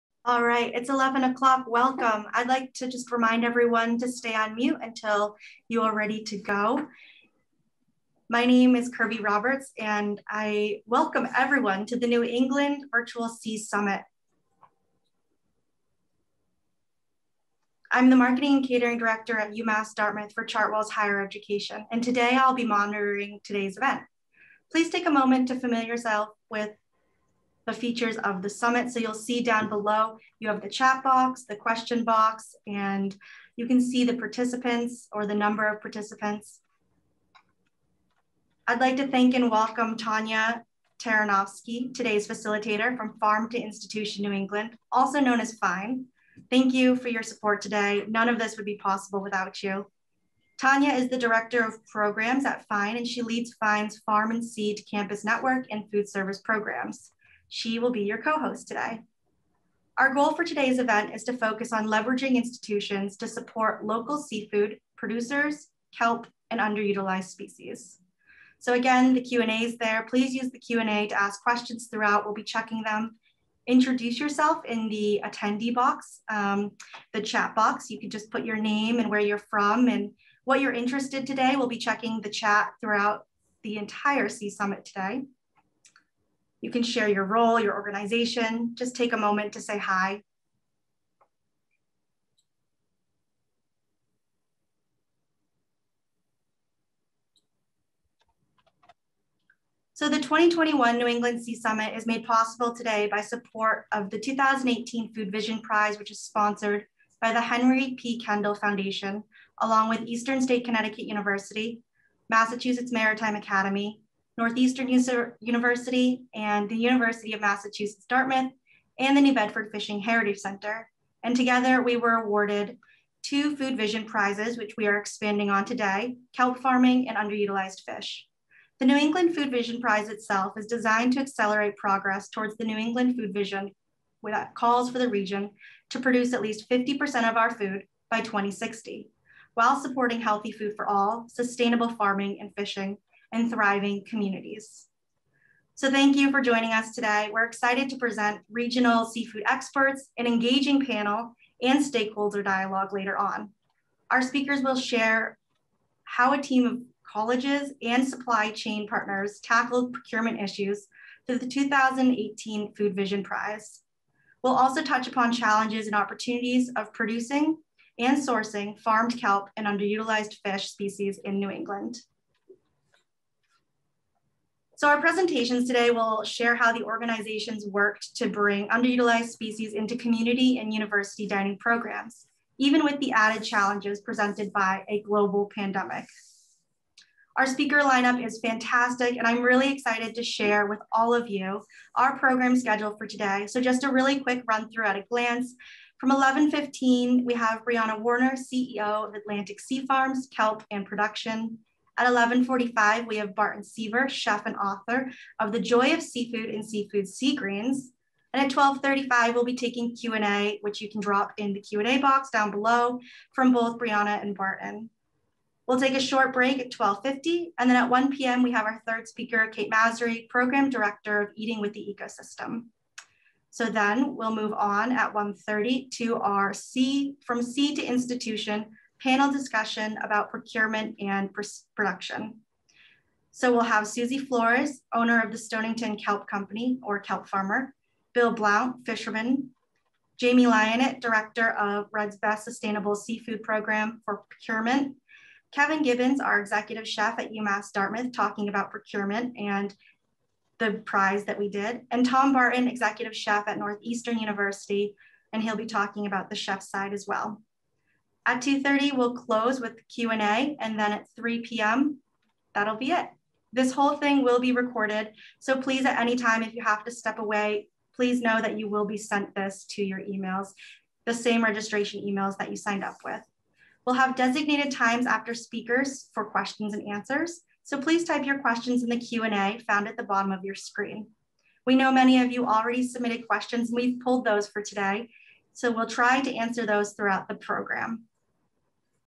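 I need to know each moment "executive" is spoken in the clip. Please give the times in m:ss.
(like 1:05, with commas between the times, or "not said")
4:06, 4:12.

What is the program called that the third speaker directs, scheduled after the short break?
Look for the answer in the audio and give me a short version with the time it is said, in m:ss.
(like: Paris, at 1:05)
Eating with the Ecosystem, at 3:41.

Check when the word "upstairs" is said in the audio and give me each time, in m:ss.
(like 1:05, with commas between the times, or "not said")
not said.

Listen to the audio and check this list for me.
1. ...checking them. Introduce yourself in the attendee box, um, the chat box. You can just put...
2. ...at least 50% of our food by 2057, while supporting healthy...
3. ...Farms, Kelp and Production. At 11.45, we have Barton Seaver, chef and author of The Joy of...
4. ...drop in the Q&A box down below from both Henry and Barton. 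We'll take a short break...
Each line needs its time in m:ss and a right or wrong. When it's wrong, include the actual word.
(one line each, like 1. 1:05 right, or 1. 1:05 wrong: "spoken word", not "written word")
1. 1:12 right
2. 2:16 wrong: "2060", not "2057"
3. 3:19 right
4. 3:30 wrong: "Briana", not "Henry".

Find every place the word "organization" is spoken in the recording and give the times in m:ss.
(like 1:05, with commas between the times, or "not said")
1:27, 2:56.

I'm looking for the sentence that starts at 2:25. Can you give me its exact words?
So thank you for joining us today.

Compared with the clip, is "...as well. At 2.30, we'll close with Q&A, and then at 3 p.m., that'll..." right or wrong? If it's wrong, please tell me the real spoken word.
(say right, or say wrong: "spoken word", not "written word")
right.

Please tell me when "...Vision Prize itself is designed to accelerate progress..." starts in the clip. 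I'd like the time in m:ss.
2:09.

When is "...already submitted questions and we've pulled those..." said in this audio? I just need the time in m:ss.
4:42.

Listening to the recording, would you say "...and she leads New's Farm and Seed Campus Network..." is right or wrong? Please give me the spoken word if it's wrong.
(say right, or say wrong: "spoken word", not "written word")
wrong: "FINE", not "New".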